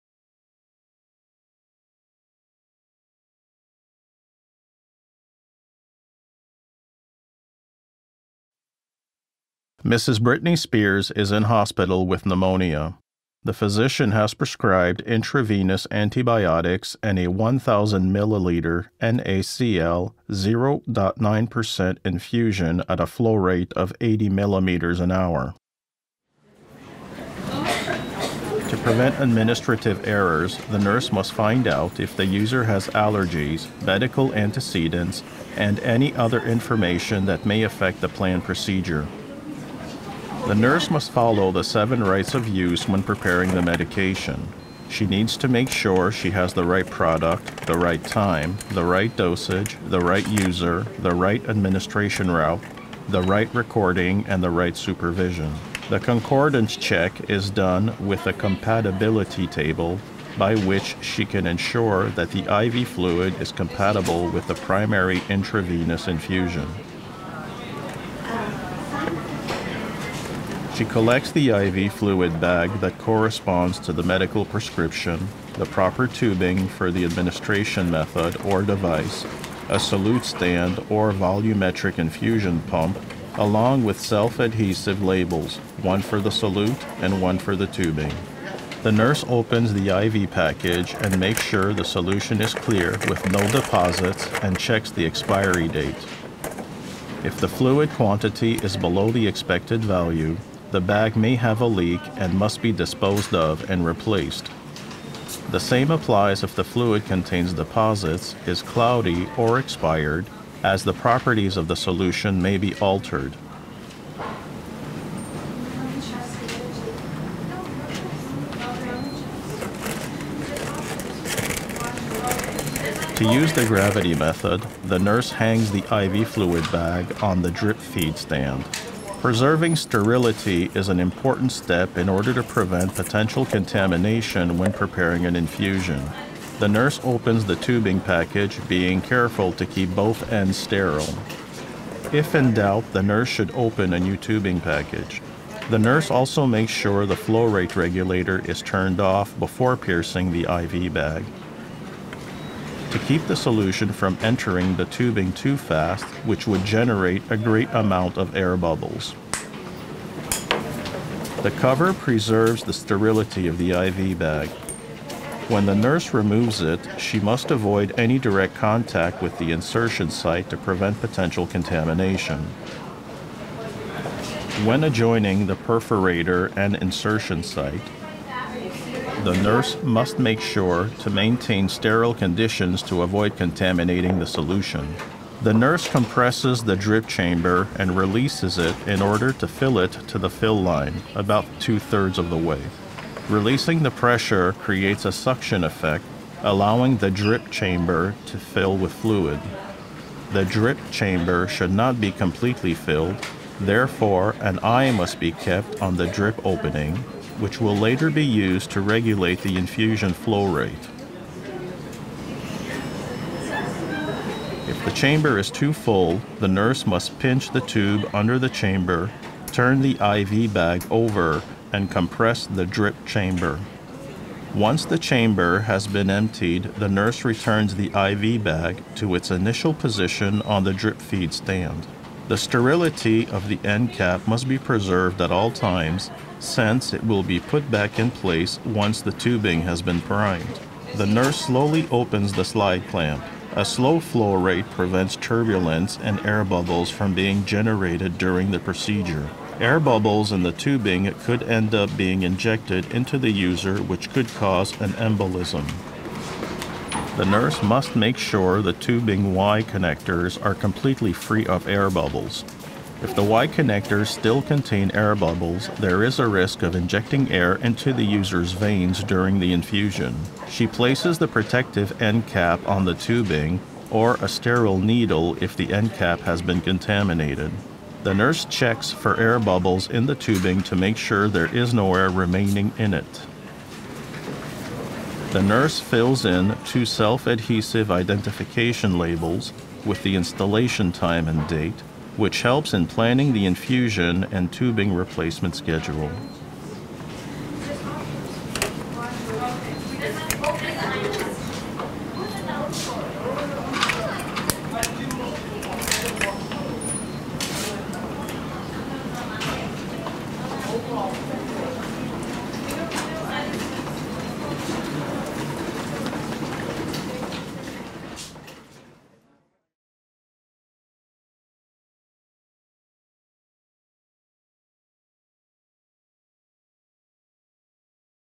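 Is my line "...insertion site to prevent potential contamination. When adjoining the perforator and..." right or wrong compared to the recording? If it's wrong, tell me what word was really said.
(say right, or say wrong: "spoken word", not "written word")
right.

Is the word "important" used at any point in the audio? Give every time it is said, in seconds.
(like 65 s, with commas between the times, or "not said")
130 s.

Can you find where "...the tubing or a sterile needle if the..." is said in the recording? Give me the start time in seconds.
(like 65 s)
272 s.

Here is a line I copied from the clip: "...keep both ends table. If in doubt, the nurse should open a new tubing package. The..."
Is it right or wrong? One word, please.
wrong.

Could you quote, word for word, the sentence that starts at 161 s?
The cover preserves the sterility of the IV bag.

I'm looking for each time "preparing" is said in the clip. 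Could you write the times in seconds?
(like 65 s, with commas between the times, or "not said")
43 s, 134 s.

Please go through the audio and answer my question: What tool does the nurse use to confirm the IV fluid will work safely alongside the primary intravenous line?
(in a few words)
compatibility table.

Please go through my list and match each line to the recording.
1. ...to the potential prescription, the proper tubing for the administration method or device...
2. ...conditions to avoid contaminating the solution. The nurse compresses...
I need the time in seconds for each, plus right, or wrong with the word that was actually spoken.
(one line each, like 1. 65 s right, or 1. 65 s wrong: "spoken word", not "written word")
1. 73 s wrong: "medical", not "potential"
2. 182 s right.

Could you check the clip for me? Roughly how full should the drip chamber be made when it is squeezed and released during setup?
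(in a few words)
two thirds.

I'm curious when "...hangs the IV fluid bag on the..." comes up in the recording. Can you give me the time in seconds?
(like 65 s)
125 s.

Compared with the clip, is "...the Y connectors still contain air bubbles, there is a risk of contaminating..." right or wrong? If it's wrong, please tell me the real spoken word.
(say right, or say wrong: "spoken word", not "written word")
wrong: "injecting", not "contaminating".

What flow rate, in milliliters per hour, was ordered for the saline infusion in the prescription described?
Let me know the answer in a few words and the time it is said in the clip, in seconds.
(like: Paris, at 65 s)
80 milliliters an hour, at 23 s.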